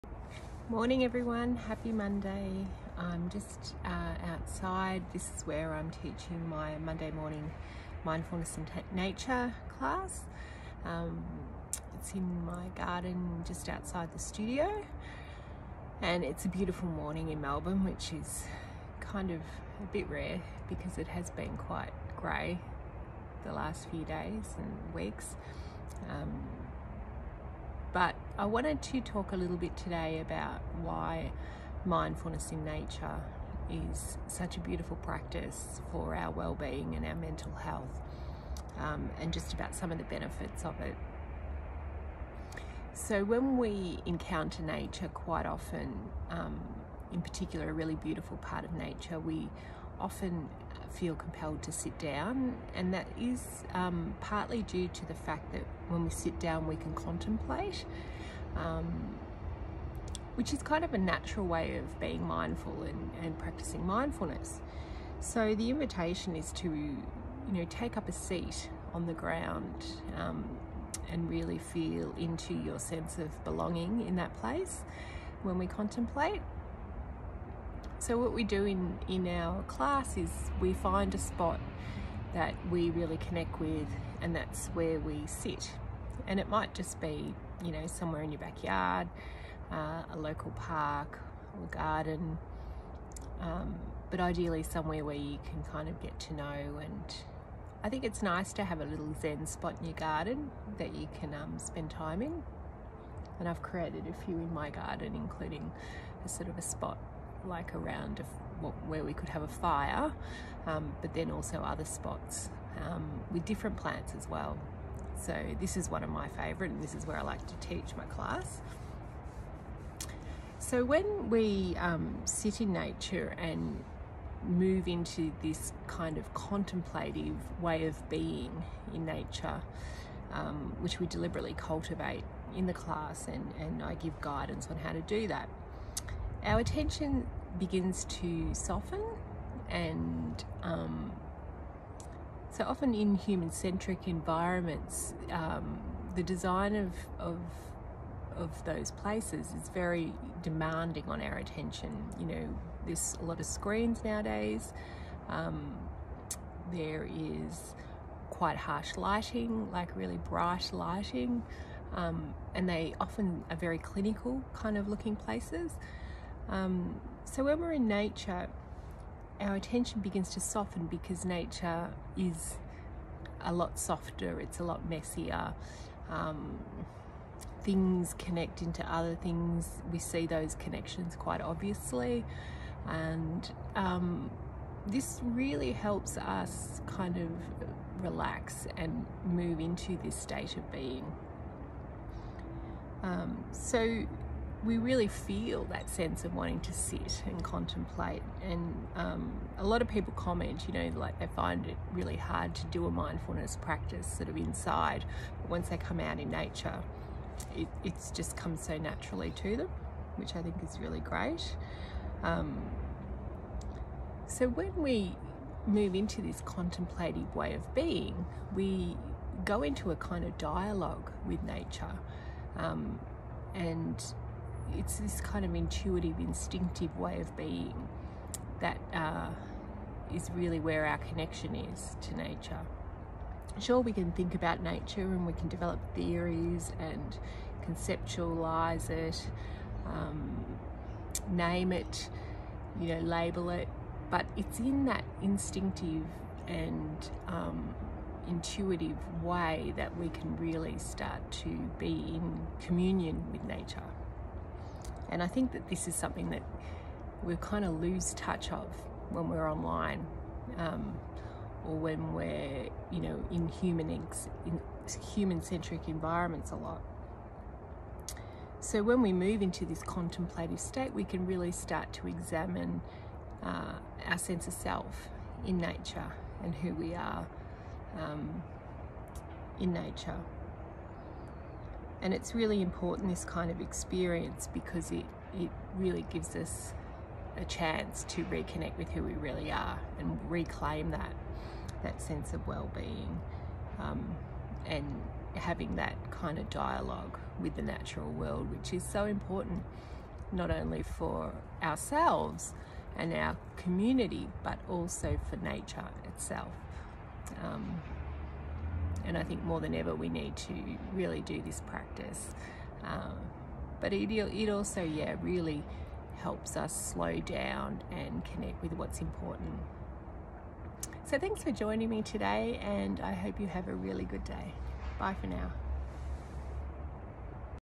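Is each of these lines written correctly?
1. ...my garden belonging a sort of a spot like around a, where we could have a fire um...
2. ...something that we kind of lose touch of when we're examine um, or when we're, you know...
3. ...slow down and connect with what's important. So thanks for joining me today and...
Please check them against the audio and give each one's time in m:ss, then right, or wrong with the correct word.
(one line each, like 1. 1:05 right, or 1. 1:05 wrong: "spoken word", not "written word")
1. 1:44 wrong: "including", not "belonging"
2. 4:15 wrong: "online", not "examine"
3. 5:16 right.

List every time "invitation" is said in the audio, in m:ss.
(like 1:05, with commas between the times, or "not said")
1:05.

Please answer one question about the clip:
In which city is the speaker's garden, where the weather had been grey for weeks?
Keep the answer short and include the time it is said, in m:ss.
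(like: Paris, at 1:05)
Melbourne, at 0:17.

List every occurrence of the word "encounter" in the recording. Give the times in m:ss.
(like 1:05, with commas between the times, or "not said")
0:44.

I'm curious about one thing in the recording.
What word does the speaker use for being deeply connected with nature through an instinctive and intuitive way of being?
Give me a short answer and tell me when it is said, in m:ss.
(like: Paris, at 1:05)
Communion, at 4:12.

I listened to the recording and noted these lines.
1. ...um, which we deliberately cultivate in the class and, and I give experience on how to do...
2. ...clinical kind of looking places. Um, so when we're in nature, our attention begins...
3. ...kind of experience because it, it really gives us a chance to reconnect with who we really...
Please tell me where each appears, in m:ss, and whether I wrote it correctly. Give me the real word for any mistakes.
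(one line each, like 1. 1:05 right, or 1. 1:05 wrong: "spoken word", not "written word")
1. 2:10 wrong: "guidance", not "experience"
2. 2:43 right
3. 4:43 right.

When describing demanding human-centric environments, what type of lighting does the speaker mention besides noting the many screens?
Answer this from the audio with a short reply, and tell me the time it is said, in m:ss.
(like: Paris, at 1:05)
Harsh lighting, at 2:38.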